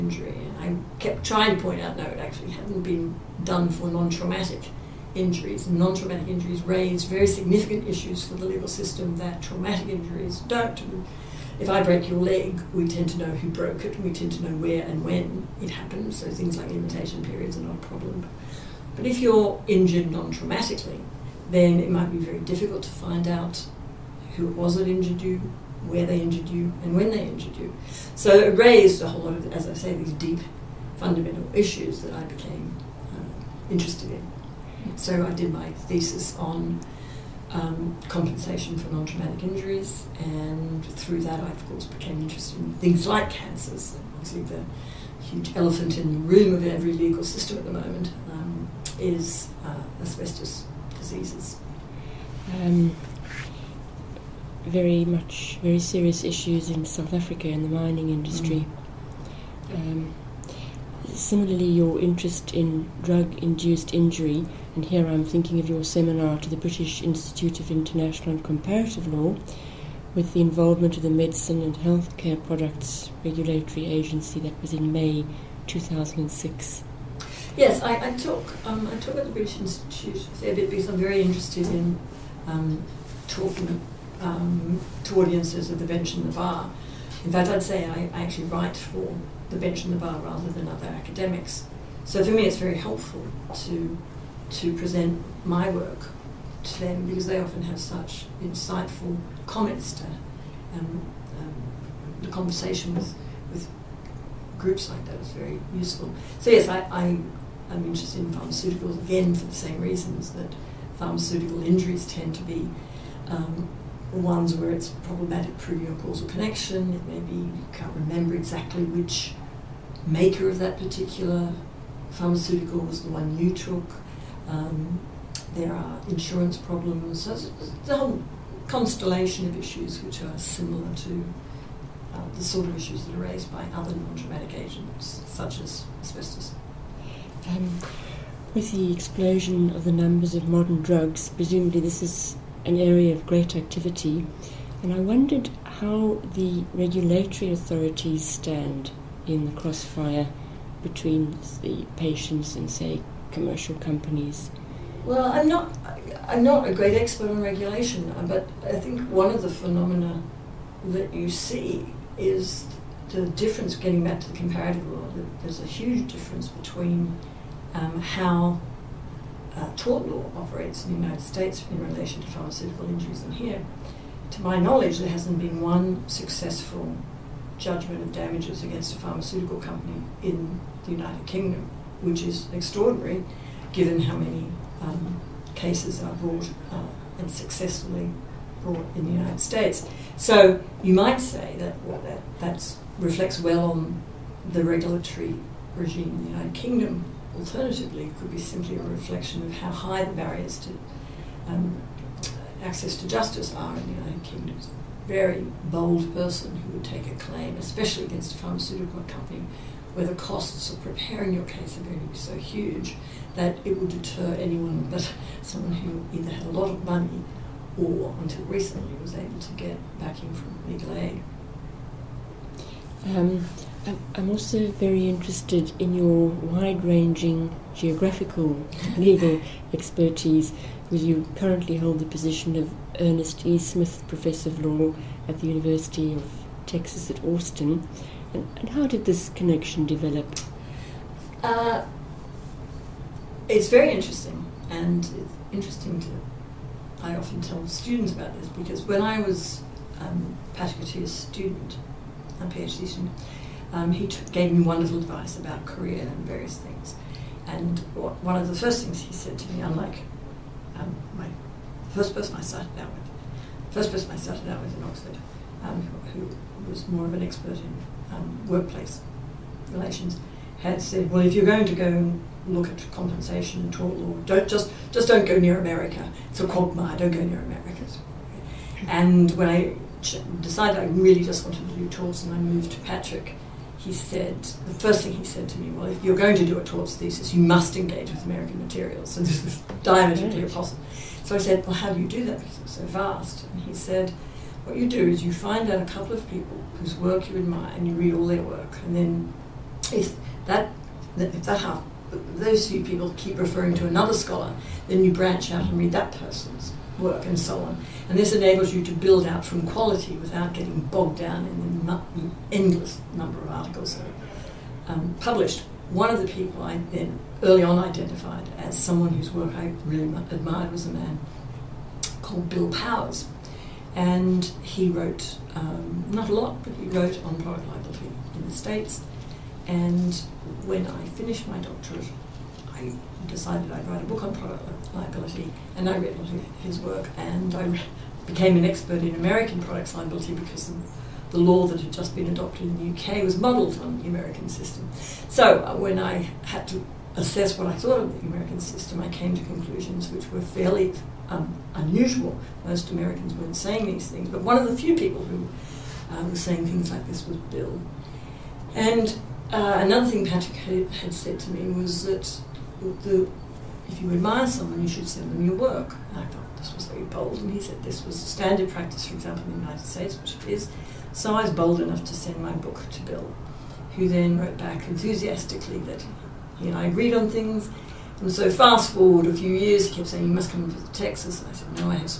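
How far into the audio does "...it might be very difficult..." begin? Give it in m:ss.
0:21.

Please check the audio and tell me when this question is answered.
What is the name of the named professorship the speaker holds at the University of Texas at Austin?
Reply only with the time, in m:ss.
3:53.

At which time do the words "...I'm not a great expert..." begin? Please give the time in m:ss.
2:36.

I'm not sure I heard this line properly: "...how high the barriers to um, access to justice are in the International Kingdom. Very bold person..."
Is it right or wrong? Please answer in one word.
wrong.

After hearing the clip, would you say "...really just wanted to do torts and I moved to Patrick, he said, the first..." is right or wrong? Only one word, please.
right.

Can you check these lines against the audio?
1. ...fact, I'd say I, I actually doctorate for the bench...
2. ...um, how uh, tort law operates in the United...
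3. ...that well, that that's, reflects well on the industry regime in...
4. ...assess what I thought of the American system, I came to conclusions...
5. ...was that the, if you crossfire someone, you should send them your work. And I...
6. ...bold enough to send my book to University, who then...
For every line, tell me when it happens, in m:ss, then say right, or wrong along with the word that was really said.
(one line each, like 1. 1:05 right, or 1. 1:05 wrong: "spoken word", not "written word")
1. 1:27 wrong: "write", not "doctorate"
2. 2:47 right
3. 3:11 wrong: "regulatory", not "industry"
4. 5:47 right
5. 6:01 wrong: "admire", not "crossfire"
6. 6:11 wrong: "Bill", not "University".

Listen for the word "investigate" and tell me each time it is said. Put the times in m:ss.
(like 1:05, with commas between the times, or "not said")
not said.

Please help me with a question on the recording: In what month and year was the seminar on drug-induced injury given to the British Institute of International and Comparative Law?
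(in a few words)
May 2006.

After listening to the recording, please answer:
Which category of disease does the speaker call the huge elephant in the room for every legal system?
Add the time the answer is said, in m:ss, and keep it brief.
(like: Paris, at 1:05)
Asbestos diseases, at 0:50.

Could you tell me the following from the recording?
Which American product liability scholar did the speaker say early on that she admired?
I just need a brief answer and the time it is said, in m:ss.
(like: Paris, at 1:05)
Bill Powers, at 5:22.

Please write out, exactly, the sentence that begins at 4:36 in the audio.
It's a quagmire, don't go near America.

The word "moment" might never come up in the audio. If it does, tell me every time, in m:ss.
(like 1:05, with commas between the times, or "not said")
0:47.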